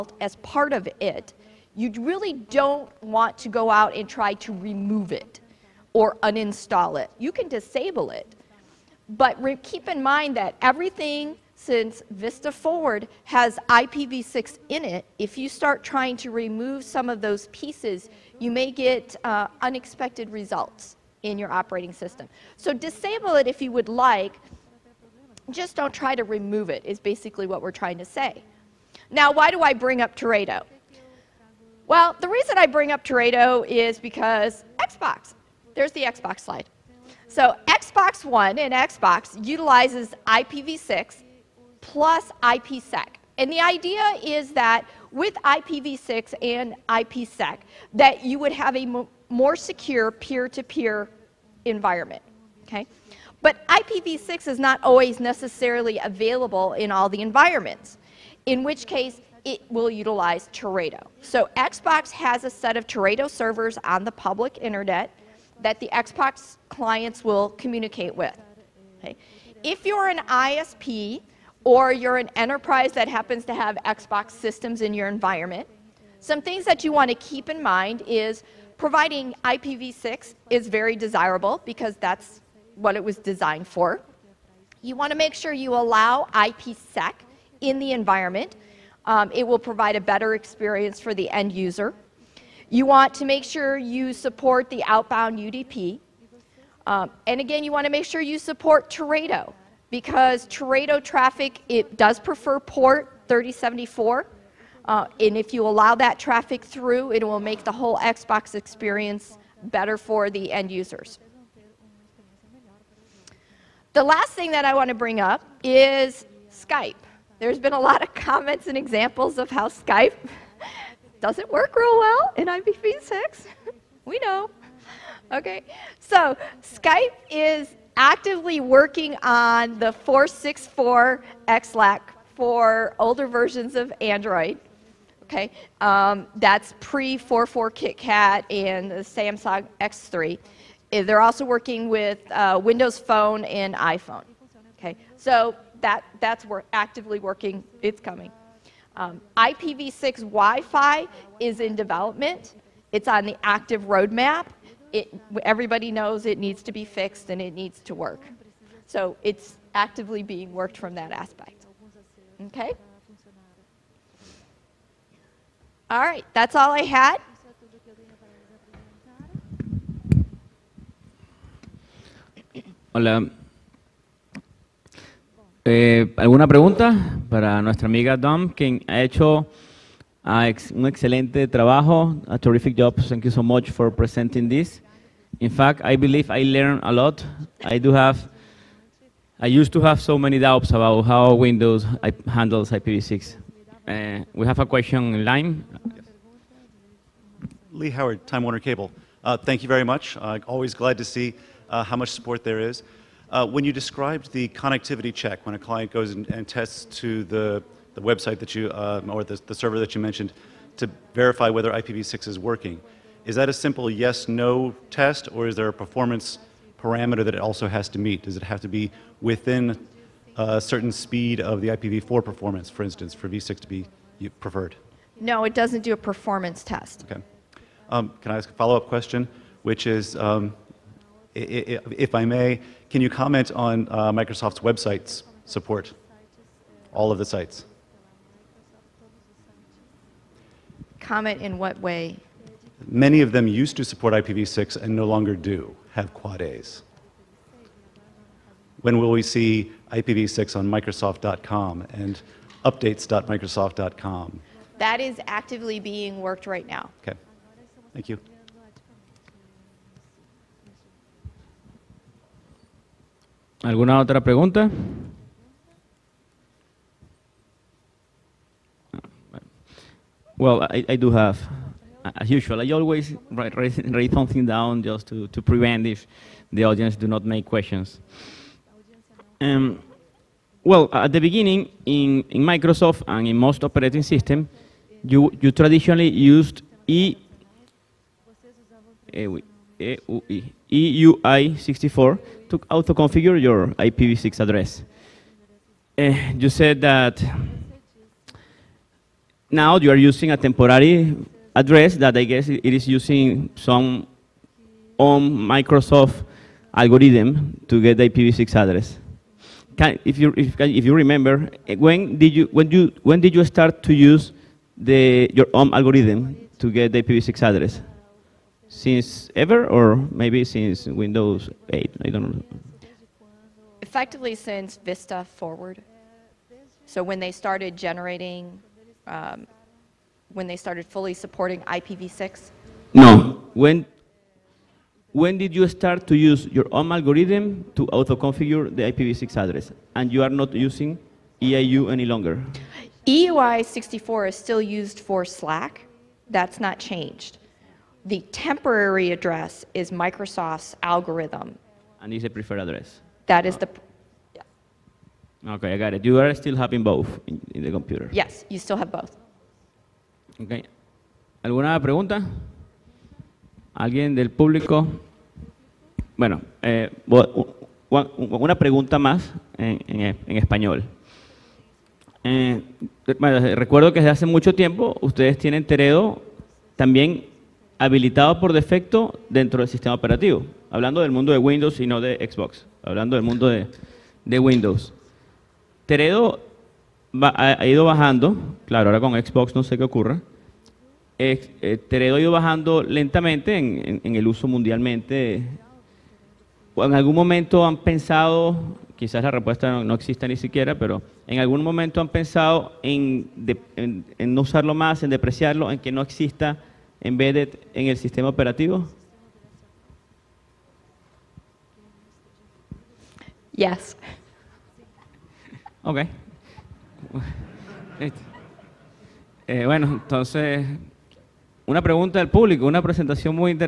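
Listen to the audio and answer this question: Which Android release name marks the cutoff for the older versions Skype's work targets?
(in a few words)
KitKat.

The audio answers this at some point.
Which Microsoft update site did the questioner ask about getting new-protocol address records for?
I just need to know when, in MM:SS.
04:12.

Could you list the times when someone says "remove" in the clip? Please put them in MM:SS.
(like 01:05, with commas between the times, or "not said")
00:04, 00:16, 00:26.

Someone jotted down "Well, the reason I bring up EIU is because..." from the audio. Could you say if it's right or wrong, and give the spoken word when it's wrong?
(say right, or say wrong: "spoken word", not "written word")
wrong: "Teredo", not "EIU".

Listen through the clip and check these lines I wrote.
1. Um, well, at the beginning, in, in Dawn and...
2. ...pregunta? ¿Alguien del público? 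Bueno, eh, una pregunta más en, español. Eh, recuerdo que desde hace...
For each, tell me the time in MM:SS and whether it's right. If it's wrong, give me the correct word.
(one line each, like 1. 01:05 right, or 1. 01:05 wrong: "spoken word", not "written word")
1. 04:39 wrong: "Microsoft", not "Dawn"
2. 06:01 right.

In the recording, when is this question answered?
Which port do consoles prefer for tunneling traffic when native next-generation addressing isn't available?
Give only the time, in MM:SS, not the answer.
01:43.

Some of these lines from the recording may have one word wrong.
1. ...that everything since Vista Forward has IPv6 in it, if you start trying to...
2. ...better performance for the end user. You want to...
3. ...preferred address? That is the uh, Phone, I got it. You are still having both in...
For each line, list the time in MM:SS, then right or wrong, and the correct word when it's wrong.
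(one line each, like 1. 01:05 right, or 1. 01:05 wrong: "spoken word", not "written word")
1. 00:10 right
2. 01:29 wrong: "experience", not "performance"
3. 05:52 wrong: "Okay", not "Phone".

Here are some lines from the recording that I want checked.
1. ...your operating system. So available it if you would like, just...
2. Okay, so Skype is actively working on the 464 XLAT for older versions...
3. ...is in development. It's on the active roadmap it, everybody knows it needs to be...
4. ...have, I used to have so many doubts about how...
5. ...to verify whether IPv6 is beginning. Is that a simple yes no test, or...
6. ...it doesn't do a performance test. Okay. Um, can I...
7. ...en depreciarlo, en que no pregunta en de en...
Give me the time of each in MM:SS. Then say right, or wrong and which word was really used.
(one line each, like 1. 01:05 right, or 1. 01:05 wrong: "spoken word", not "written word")
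1. 00:21 wrong: "disable", not "available"
2. 02:05 right
3. 02:31 right
4. 03:07 right
5. 03:30 wrong: "working", not "beginning"
6. 03:45 right
7. 06:45 wrong: "exista", not "pregunta".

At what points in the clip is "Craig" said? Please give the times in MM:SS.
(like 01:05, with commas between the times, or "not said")
not said.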